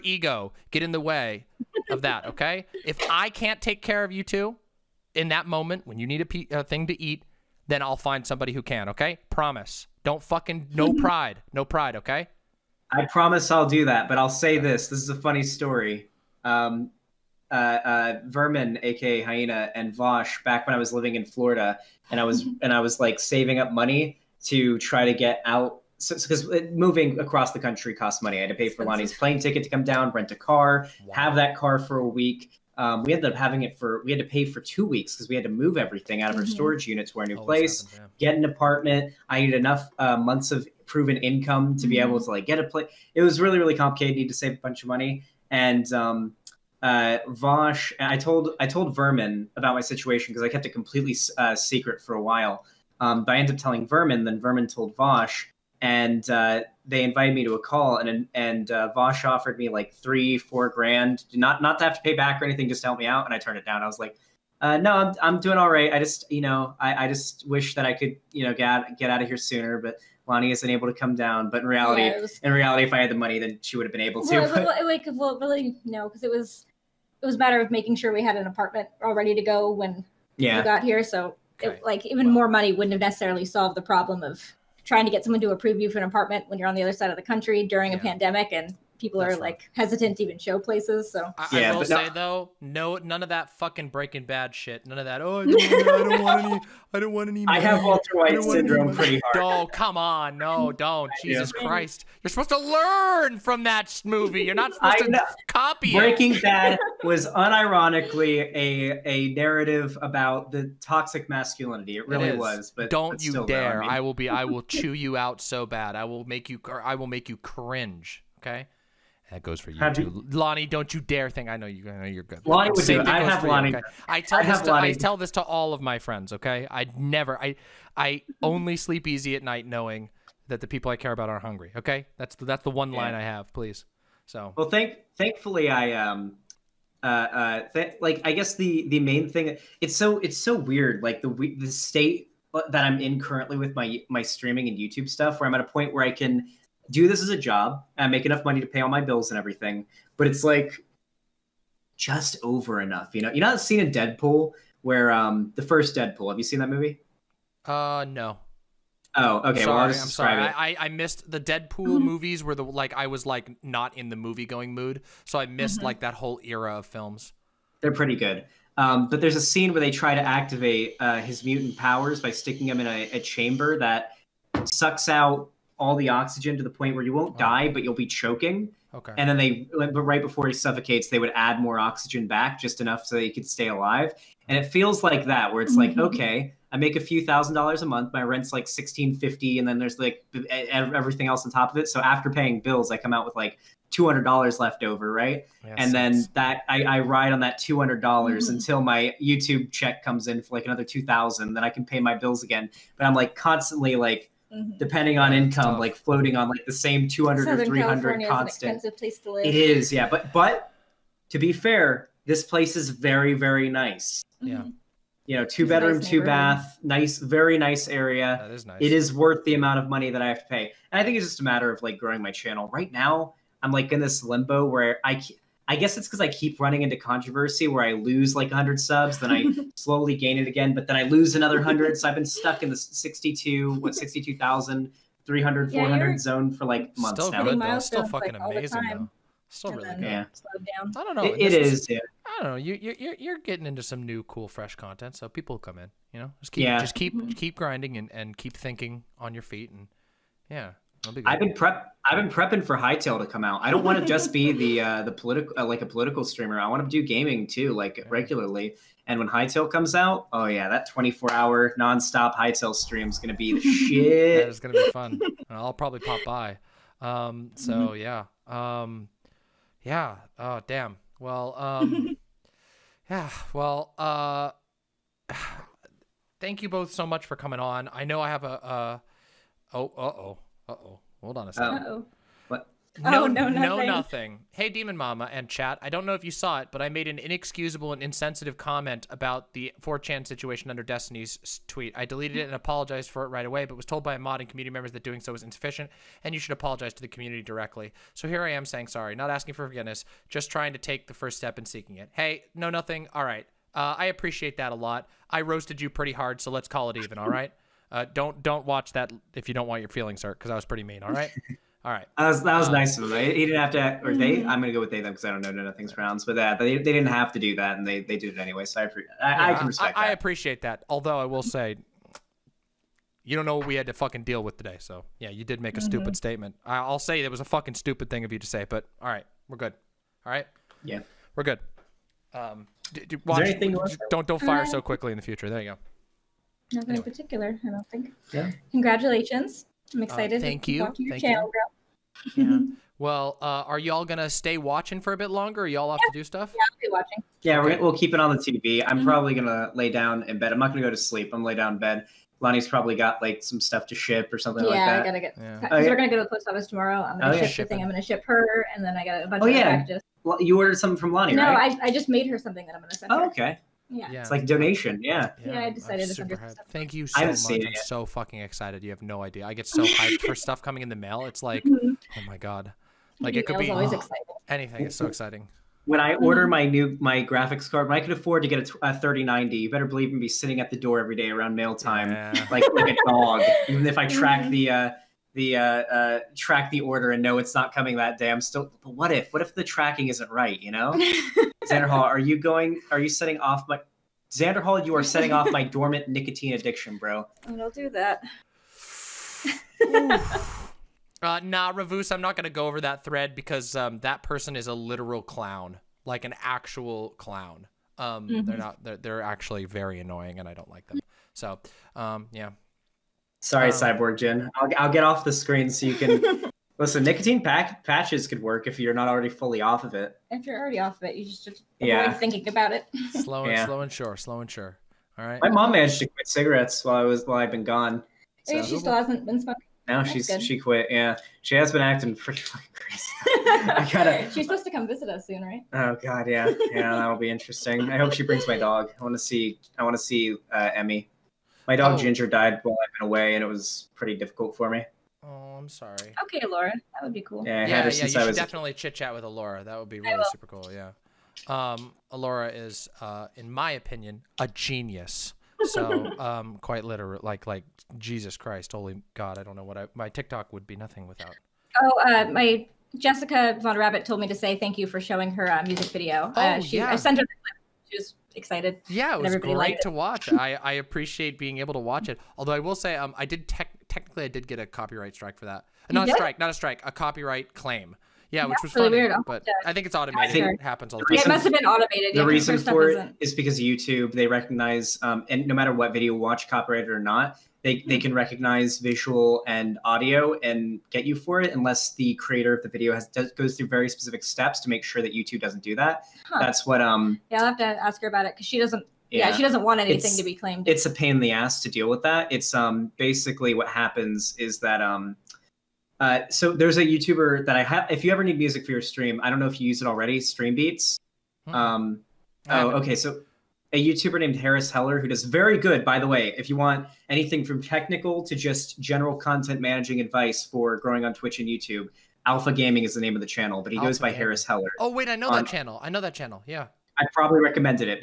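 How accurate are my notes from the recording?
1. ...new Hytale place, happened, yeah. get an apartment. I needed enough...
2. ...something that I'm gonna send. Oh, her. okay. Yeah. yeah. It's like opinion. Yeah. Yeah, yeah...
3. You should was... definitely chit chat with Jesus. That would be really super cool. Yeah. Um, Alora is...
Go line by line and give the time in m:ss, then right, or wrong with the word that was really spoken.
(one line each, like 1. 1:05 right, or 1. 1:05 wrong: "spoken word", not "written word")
1. 0:37 wrong: "Always", not "Hytale"
2. 6:02 wrong: "donation", not "opinion"
3. 7:27 wrong: "Laura", not "Jesus".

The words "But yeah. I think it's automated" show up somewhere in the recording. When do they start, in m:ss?
7:59.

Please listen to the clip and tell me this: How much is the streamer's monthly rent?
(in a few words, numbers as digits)
1650.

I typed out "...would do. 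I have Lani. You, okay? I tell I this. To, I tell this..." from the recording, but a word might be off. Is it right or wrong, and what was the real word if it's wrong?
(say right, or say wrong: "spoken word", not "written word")
right.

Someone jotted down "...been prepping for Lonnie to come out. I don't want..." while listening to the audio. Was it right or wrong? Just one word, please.
wrong.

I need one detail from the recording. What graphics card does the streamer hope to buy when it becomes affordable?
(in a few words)
3090.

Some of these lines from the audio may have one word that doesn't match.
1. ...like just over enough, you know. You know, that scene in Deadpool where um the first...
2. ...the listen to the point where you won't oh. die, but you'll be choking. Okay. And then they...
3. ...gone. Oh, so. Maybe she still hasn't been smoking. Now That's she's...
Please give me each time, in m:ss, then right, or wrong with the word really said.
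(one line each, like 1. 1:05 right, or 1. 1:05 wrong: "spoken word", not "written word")
1. 2:30 right
2. 2:55 wrong: "oxygen", not "listen"
3. 7:07 right.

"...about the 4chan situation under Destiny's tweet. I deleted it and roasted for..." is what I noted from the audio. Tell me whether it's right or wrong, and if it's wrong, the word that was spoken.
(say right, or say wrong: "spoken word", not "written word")
wrong: "apologized", not "roasted".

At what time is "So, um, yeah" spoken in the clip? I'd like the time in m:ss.
6:51.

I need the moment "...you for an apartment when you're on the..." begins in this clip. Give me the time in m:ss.
1:25.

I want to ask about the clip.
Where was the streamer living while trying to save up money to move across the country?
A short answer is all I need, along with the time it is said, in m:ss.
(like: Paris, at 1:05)
Florida, at 0:21.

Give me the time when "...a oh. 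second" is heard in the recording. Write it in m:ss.
4:41.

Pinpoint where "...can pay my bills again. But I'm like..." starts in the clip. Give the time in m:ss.
3:21.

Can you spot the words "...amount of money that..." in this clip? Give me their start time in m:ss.
3:39.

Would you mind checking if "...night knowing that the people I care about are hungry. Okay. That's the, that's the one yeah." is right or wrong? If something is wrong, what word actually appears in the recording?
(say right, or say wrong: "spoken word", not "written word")
right.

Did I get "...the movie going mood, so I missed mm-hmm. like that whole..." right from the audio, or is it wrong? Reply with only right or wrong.
right.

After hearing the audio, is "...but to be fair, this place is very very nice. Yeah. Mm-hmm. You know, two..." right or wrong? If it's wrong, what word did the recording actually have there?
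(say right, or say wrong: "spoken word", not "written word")
right.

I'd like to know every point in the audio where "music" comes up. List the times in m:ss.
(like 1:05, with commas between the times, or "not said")
7:45, 8:28.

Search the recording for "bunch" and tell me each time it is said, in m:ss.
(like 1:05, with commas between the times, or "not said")
0:44, 5:59.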